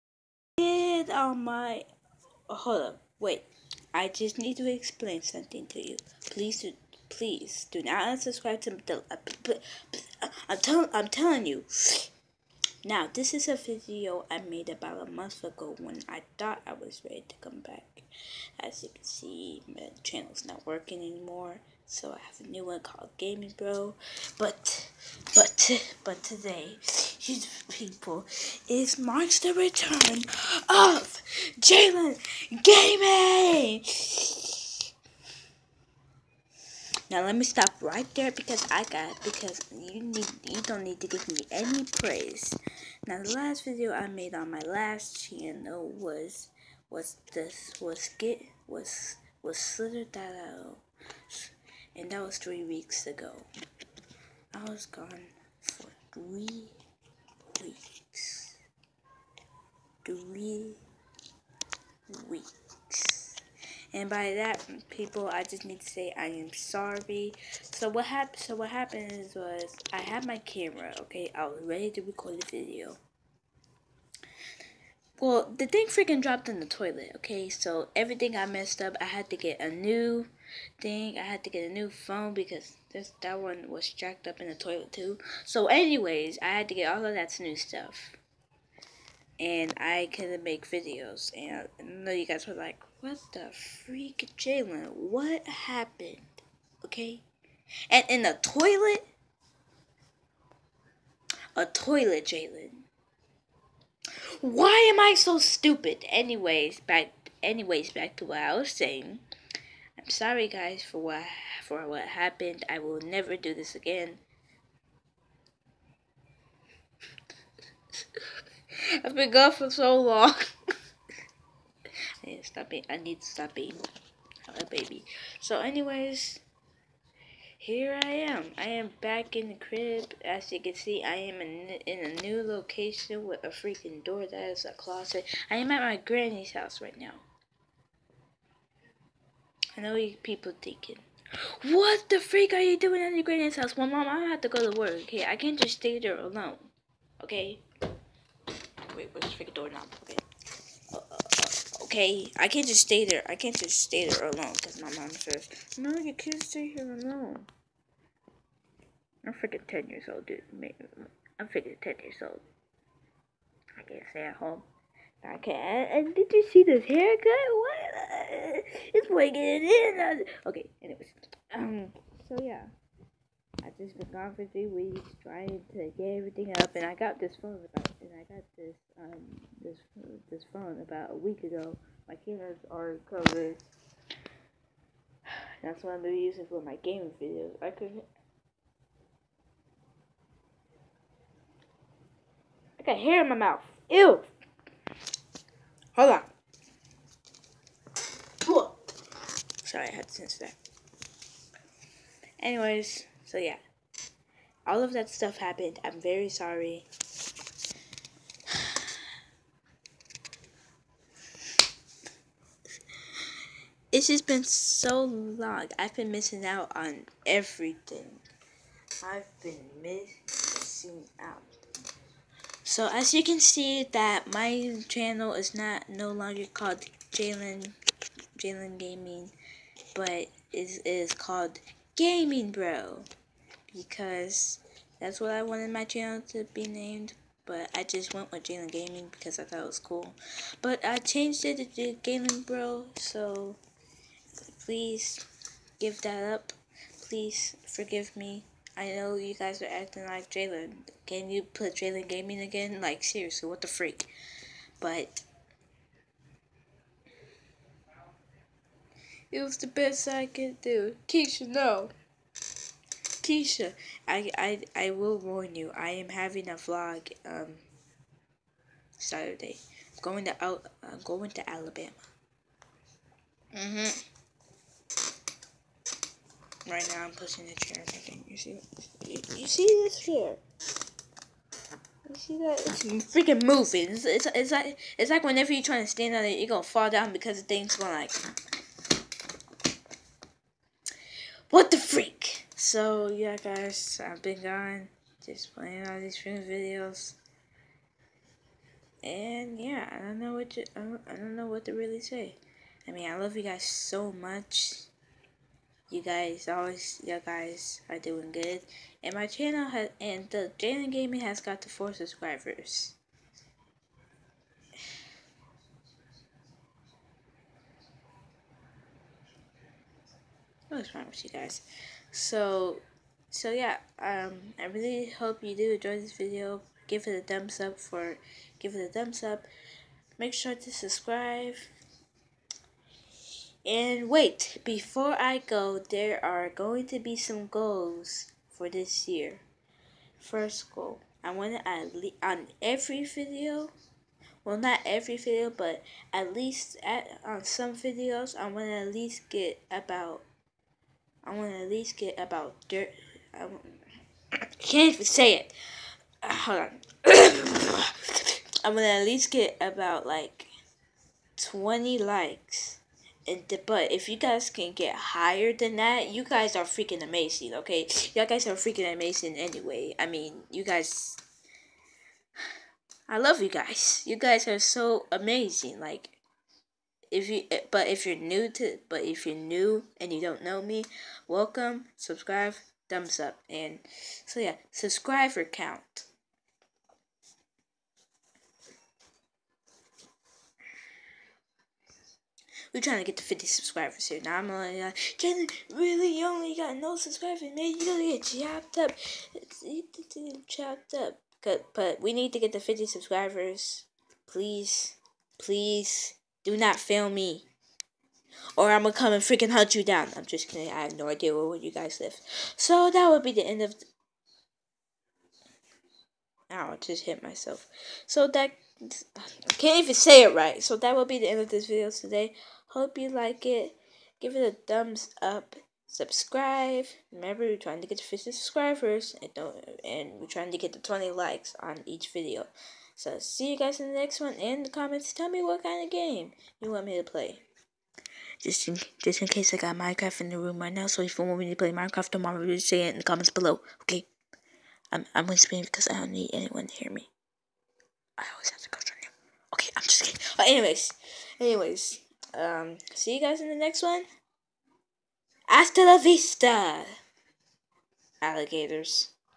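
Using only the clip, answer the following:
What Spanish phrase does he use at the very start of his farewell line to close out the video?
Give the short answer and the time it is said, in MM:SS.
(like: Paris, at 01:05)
Hasta la vista, at 07:35.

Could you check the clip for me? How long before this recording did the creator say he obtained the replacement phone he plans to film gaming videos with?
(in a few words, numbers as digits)
a week ago.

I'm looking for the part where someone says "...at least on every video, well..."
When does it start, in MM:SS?
05:41.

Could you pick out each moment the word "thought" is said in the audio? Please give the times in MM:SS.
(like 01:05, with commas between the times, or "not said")
00:16, 03:59.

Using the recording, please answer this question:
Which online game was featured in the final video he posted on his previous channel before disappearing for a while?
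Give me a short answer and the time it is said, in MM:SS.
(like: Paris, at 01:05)
slither.io, at 00:49.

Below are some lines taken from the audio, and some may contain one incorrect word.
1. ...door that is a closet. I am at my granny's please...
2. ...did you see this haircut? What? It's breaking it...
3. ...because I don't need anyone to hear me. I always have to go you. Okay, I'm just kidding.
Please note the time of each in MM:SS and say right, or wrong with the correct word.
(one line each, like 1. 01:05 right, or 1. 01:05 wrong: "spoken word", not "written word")
1. 02:14 wrong: "house", not "please"
2. 02:46 right
3. 07:25 right.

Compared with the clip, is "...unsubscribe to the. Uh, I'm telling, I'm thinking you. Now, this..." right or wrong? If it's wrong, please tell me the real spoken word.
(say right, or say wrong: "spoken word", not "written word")
wrong: "telling", not "thinking".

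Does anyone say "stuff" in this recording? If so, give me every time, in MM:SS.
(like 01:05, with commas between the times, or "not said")
01:27, 03:25.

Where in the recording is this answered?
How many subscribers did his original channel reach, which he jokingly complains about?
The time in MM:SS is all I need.
05:11.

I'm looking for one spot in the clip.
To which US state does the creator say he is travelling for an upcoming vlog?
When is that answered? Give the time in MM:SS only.
04:31.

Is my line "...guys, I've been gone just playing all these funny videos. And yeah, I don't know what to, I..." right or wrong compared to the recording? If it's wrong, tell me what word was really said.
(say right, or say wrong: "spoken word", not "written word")
right.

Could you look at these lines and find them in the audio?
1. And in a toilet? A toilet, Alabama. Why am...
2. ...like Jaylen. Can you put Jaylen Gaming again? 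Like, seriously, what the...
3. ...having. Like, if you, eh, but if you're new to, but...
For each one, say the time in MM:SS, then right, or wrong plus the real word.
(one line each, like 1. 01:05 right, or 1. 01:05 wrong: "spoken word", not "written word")
1. 01:37 wrong: "Jaylen", not "Alabama"
2. 04:10 right
3. 06:15 wrong: "amazing", not "having".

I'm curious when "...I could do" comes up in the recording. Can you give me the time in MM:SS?
04:20.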